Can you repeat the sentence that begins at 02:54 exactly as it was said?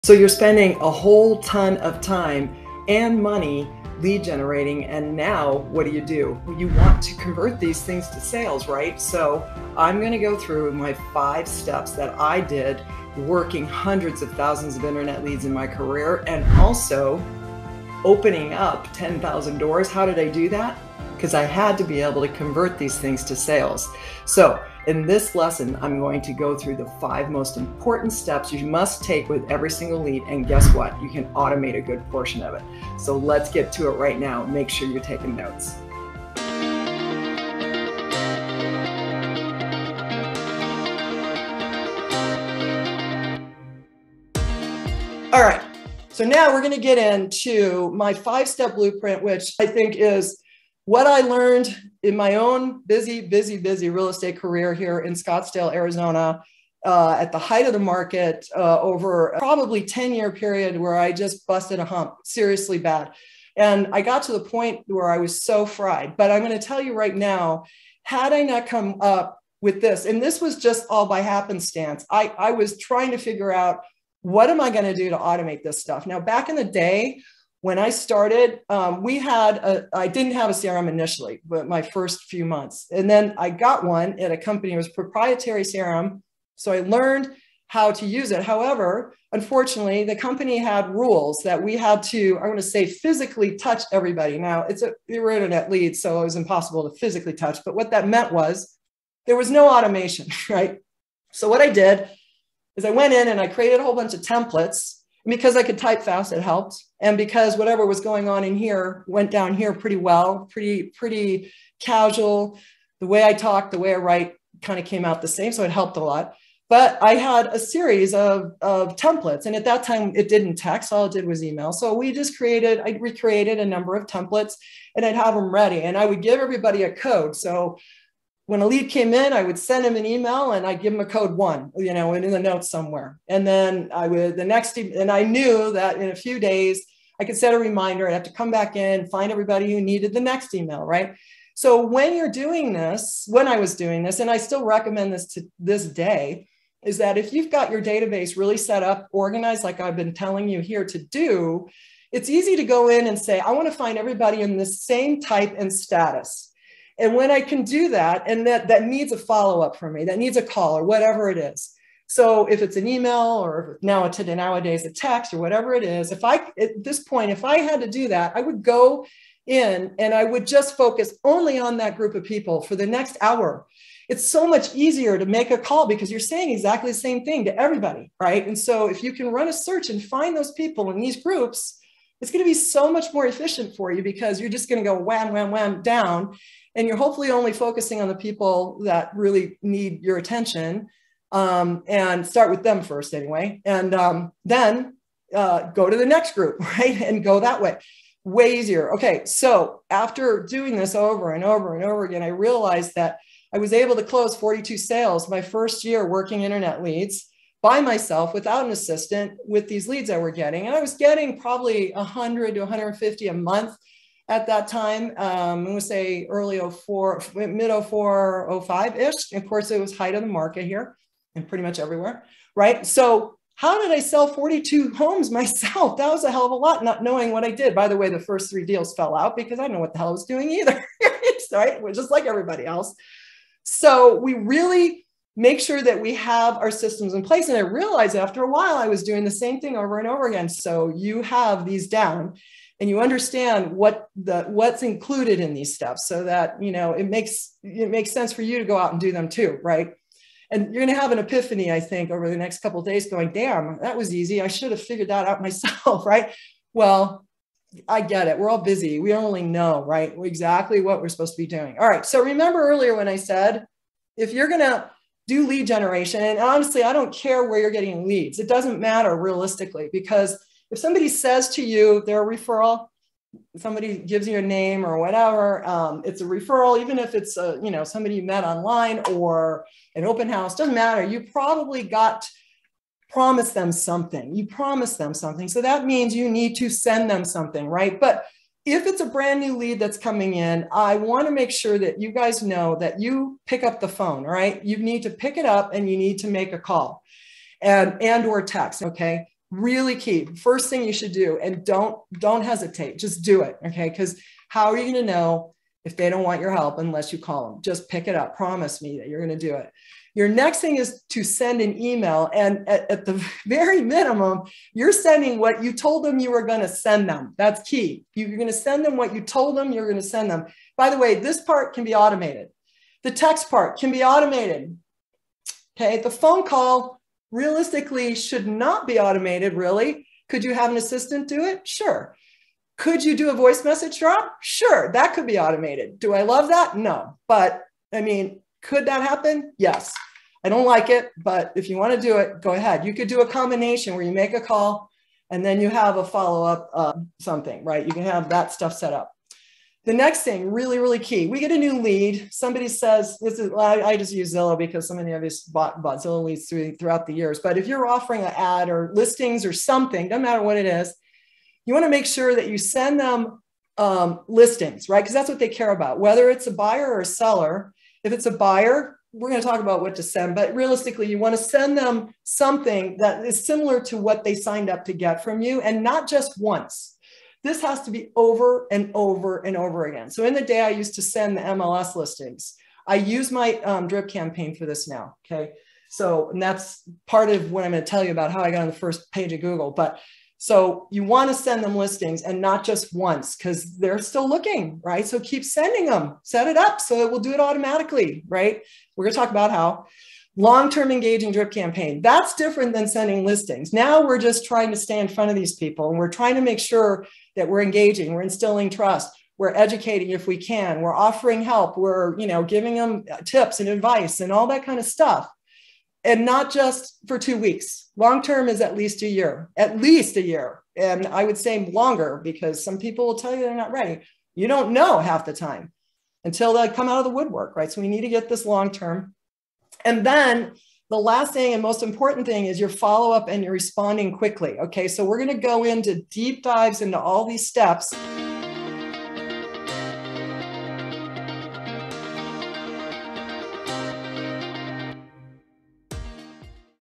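It's so much easier to make a call because you're saying exactly the same thing to everybody, right?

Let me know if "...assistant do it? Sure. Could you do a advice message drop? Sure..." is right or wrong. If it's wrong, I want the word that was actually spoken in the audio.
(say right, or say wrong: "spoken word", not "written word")
wrong: "voice", not "advice".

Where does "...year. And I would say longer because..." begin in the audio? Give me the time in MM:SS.
07:00.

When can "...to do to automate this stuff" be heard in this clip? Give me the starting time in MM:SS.
01:14.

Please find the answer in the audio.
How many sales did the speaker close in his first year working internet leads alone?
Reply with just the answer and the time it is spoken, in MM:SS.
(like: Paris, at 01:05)
42, at 03:24.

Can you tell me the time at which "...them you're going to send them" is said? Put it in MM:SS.
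05:19.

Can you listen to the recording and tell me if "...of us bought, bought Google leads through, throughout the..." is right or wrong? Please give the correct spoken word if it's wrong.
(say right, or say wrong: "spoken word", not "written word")
wrong: "Zillow", not "Google".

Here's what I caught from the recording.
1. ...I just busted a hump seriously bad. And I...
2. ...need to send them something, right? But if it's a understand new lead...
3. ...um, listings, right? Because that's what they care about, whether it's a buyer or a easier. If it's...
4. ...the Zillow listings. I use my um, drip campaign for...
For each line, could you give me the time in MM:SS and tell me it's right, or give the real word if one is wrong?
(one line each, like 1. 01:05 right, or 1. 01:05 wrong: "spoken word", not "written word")
1. 01:00 right
2. 04:46 wrong: "brand", not "understand"
3. 06:03 wrong: "seller", not "easier"
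4. 06:21 wrong: "MLS", not "Zillow".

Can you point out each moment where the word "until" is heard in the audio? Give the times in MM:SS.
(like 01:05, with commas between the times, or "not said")
07:06.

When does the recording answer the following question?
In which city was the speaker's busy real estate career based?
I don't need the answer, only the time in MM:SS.
00:55.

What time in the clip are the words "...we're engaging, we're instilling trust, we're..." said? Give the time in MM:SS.
06:47.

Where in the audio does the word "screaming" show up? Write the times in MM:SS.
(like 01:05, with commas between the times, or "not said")
not said.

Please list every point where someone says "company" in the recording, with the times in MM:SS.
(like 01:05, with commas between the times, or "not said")
01:24, 01:30.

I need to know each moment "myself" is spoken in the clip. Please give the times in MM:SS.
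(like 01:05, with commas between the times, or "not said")
03:27, 03:45, 04:15.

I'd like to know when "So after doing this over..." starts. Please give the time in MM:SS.
03:19.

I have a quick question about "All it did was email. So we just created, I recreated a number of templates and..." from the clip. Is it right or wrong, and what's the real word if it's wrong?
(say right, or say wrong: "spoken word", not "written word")
right.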